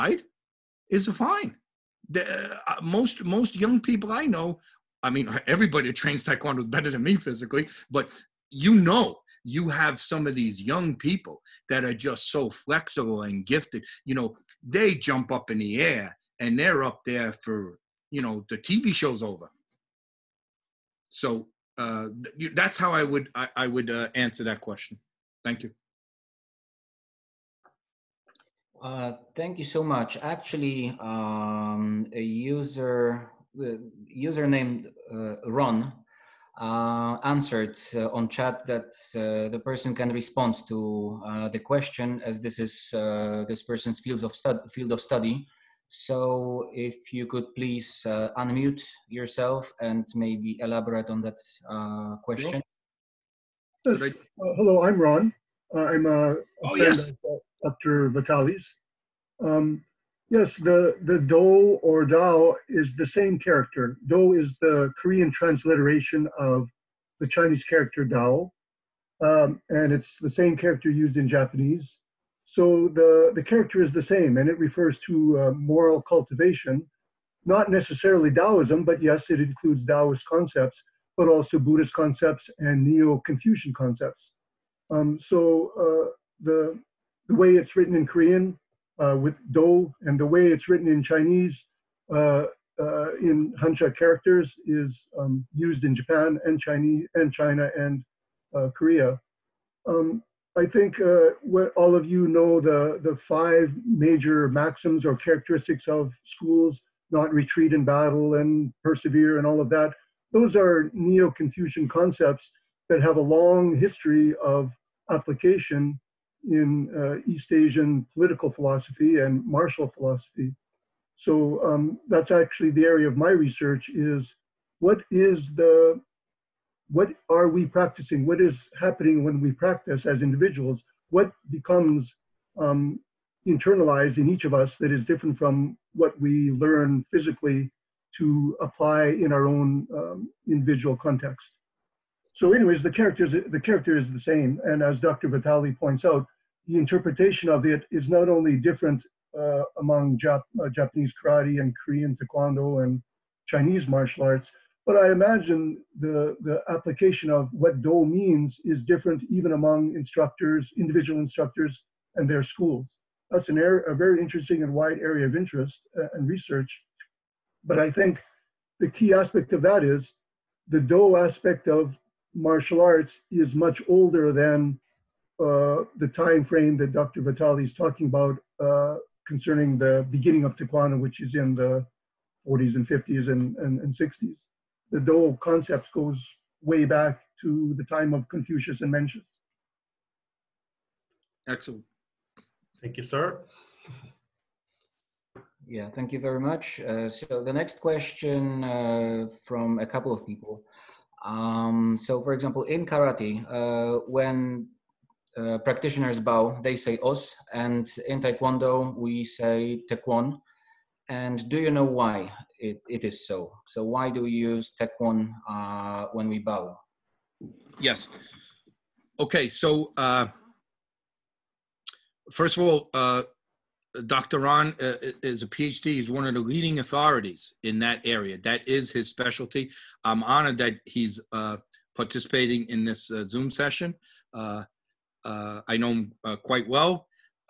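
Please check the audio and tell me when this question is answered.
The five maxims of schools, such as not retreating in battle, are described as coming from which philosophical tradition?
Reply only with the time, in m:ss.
1:50.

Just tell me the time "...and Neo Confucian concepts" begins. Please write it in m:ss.
1:22.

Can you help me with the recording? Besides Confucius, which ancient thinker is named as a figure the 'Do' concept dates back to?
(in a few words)
Mencius.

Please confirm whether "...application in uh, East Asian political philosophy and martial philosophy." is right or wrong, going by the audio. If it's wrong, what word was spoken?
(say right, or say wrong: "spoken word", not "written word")
right.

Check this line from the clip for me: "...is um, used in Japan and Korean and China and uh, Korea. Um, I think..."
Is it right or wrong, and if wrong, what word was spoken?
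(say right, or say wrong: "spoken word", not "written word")
wrong: "Chinese", not "Korean".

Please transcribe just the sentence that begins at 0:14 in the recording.
You know, they jump up in the air and they're up there for, you know, the TV show's over.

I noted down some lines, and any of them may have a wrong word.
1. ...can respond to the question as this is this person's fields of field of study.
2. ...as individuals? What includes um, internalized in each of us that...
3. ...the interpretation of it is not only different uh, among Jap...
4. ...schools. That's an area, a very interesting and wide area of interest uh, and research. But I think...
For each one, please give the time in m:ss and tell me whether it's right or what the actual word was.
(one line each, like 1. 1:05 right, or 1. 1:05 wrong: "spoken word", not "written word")
1. 0:39 right
2. 2:10 wrong: "becomes", not "includes"
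3. 2:26 right
4. 2:42 right.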